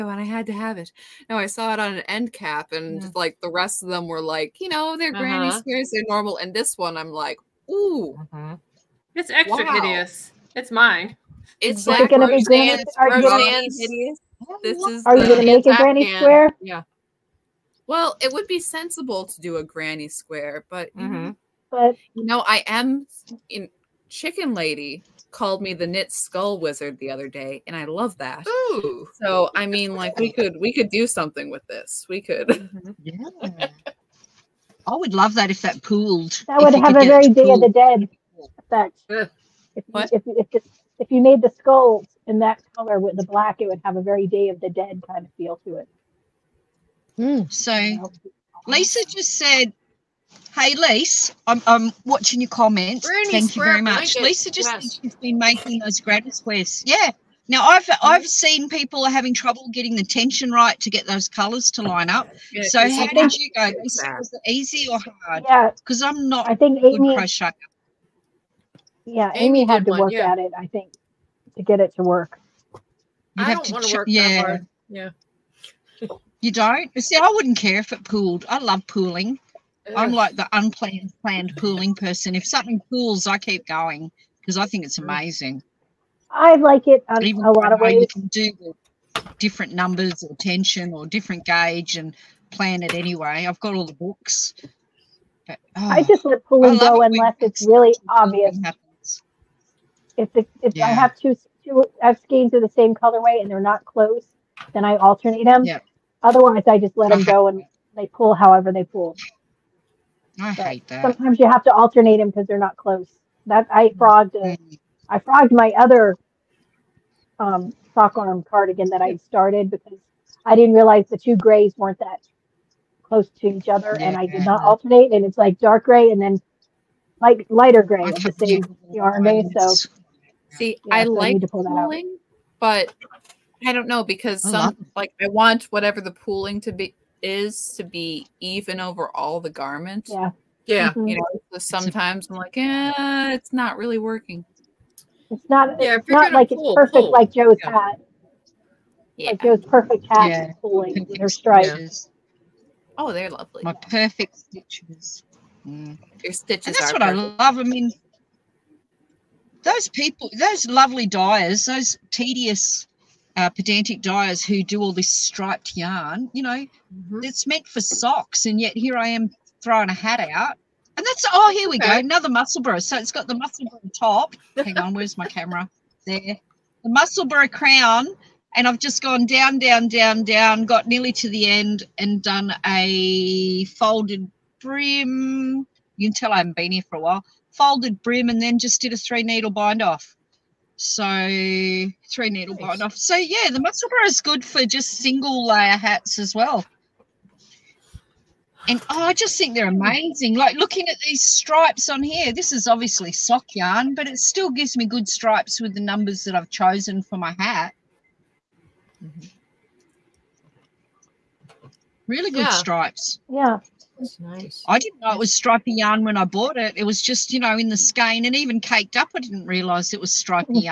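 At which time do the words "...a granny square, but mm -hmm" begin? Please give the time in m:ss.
0:19.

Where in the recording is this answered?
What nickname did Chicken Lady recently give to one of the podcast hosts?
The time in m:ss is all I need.
0:25.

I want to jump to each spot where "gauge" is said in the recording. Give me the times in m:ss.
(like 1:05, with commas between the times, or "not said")
1:31.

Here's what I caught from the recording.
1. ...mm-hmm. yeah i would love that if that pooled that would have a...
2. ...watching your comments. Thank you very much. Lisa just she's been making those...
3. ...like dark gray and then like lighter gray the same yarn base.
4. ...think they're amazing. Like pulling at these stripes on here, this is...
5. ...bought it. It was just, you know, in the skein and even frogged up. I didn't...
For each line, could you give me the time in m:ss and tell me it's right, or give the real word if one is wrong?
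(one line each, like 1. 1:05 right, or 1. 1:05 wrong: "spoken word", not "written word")
1. 0:32 right
2. 0:52 right
3. 2:05 right
4. 3:19 wrong: "looking", not "pulling"
5. 3:36 wrong: "caked", not "frogged".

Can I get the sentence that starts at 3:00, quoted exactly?
Got nearly to the end and done a folded brim.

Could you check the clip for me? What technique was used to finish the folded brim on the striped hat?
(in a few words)
three needle bind off.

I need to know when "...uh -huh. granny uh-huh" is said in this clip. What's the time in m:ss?
0:05.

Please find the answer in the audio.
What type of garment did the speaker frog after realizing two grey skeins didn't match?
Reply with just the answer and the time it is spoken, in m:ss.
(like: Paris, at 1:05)
sock arm cardigan, at 1:57.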